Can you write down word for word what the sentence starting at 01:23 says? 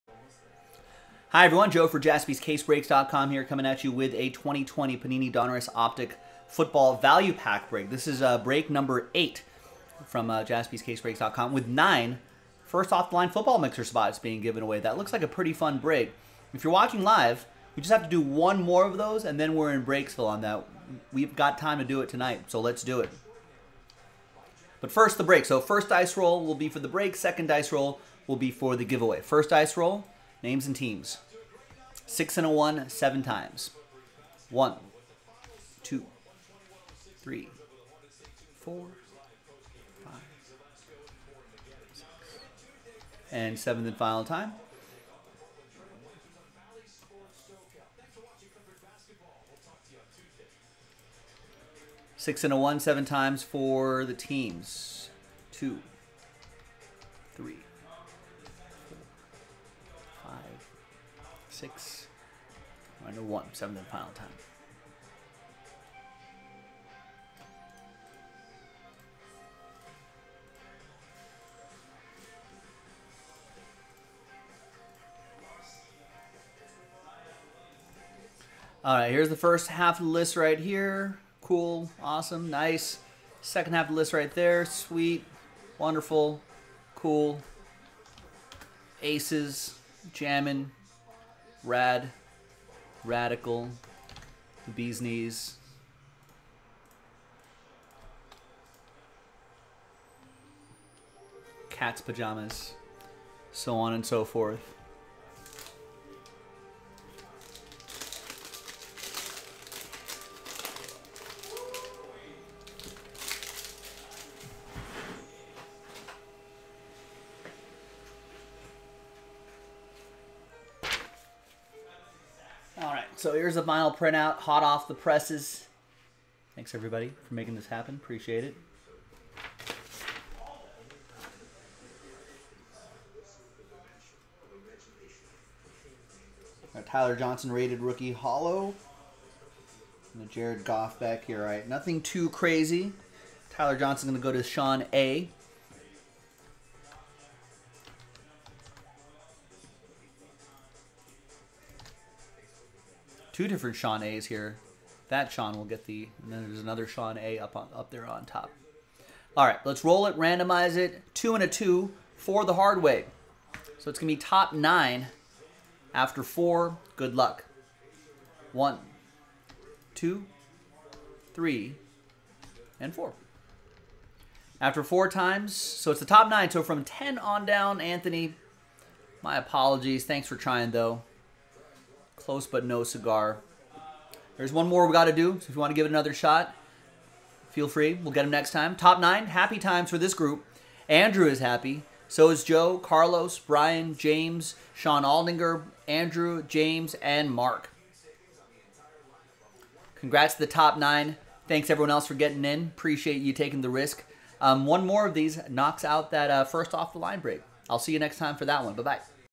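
Second half of the list right there.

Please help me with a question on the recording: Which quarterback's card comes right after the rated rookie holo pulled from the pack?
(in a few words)
Jared Goff.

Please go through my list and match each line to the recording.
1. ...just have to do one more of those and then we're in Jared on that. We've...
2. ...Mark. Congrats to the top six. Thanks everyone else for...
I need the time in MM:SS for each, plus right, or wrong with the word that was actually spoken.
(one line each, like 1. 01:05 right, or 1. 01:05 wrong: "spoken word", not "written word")
1. 00:17 wrong: "Breaksville", not "Jared"
2. 03:17 wrong: "nine", not "six".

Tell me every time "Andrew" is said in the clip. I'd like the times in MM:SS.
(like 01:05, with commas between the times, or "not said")
03:10, 03:15.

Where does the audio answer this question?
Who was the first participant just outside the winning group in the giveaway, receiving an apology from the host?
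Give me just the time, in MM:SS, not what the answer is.
02:57.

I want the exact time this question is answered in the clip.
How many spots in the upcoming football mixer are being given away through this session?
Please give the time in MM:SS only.
00:11.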